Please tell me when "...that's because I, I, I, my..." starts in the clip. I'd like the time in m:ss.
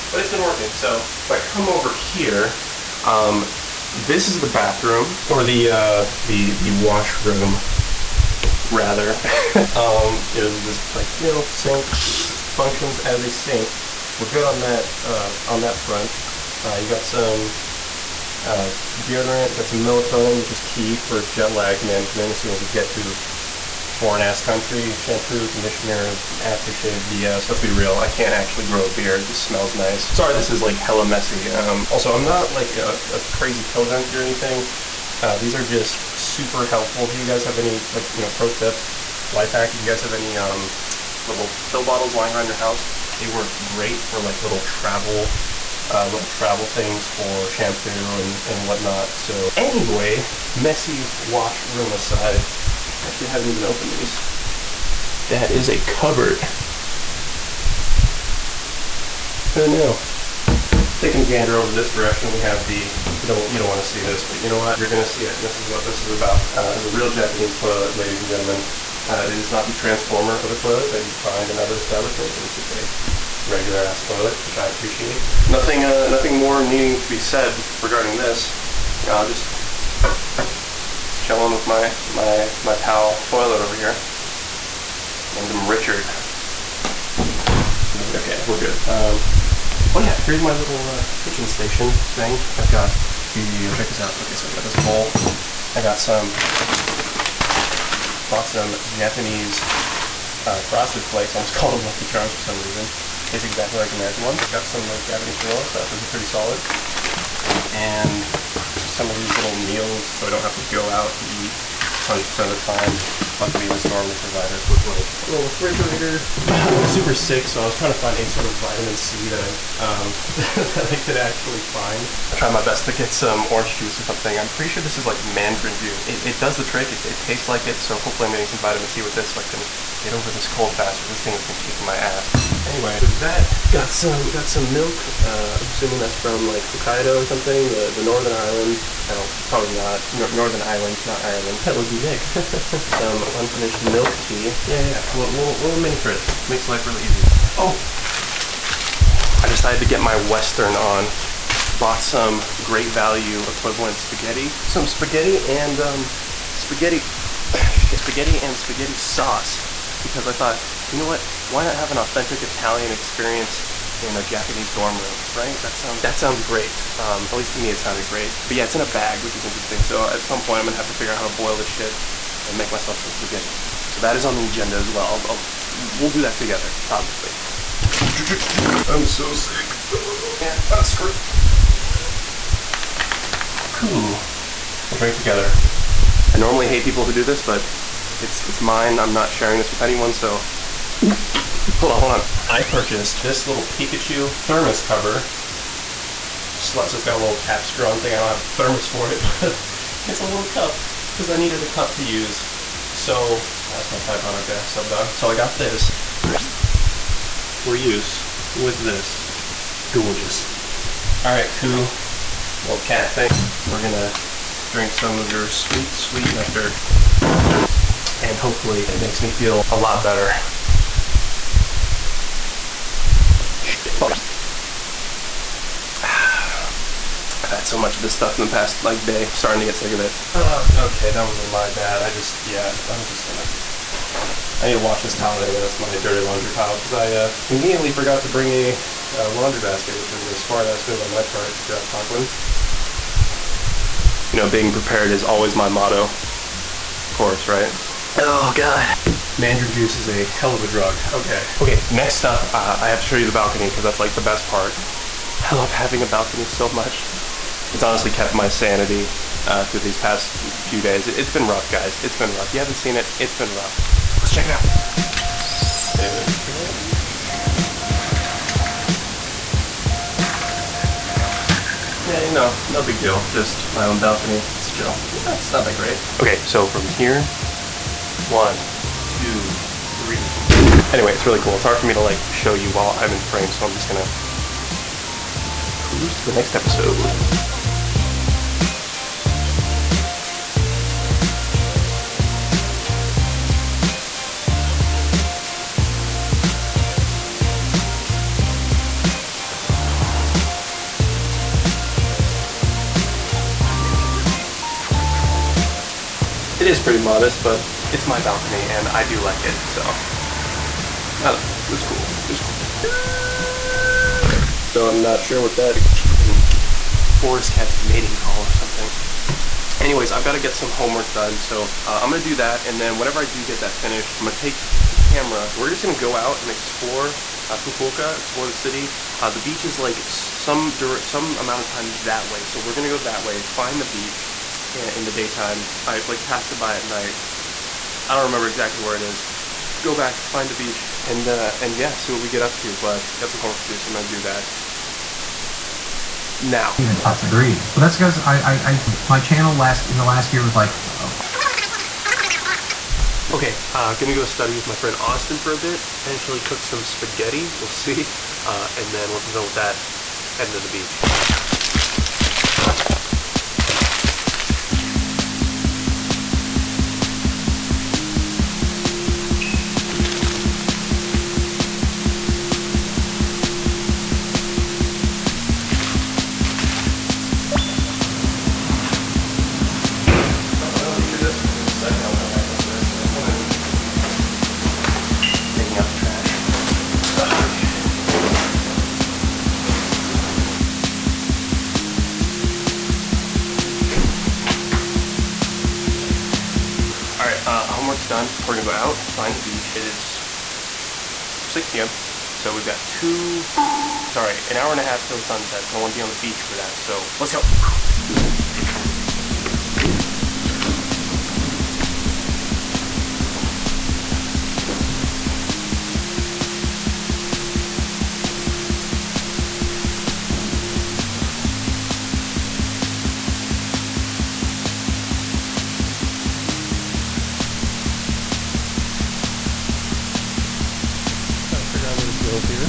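5:47.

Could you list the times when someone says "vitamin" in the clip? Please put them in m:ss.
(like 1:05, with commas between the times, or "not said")
1:58, 2:08.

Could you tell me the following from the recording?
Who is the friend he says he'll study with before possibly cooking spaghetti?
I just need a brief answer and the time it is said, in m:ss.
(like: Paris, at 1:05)
Austin, at 5:55.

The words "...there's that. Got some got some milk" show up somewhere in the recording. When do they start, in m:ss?
2:12.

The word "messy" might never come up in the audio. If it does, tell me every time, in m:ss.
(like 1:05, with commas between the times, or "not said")
0:31, 0:50.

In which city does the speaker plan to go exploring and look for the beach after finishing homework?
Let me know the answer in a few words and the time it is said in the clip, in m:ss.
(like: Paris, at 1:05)
Fukuoka, at 5:27.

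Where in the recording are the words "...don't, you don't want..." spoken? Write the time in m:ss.
1:03.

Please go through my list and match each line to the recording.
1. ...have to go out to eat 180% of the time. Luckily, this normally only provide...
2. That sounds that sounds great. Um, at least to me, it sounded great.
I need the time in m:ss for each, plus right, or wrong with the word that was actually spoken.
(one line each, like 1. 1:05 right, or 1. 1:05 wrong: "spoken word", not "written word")
1. 1:50 wrong: "100", not "180"
2. 2:45 right.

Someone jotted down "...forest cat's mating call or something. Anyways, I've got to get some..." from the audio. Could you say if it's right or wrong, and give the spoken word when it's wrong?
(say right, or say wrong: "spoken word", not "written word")
right.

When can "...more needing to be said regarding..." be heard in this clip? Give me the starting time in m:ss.
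1:16.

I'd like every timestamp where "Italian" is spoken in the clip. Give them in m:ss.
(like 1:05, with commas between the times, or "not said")
2:42.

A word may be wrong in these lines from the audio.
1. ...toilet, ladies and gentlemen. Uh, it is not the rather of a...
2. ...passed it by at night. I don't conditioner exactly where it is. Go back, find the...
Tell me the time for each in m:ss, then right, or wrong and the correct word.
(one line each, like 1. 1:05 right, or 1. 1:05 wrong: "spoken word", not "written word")
1. 1:07 wrong: "transformer", not "rather"
2. 5:36 wrong: "remember", not "conditioner".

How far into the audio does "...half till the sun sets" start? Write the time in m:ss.
6:44.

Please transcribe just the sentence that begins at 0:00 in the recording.
So if I come over here, um, this is the bathroom, or the, uh, the, the washroom, rather.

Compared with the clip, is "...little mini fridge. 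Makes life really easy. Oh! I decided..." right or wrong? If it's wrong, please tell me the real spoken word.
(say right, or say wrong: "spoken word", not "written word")
right.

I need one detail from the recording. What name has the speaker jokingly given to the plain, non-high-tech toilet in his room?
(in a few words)
Richard.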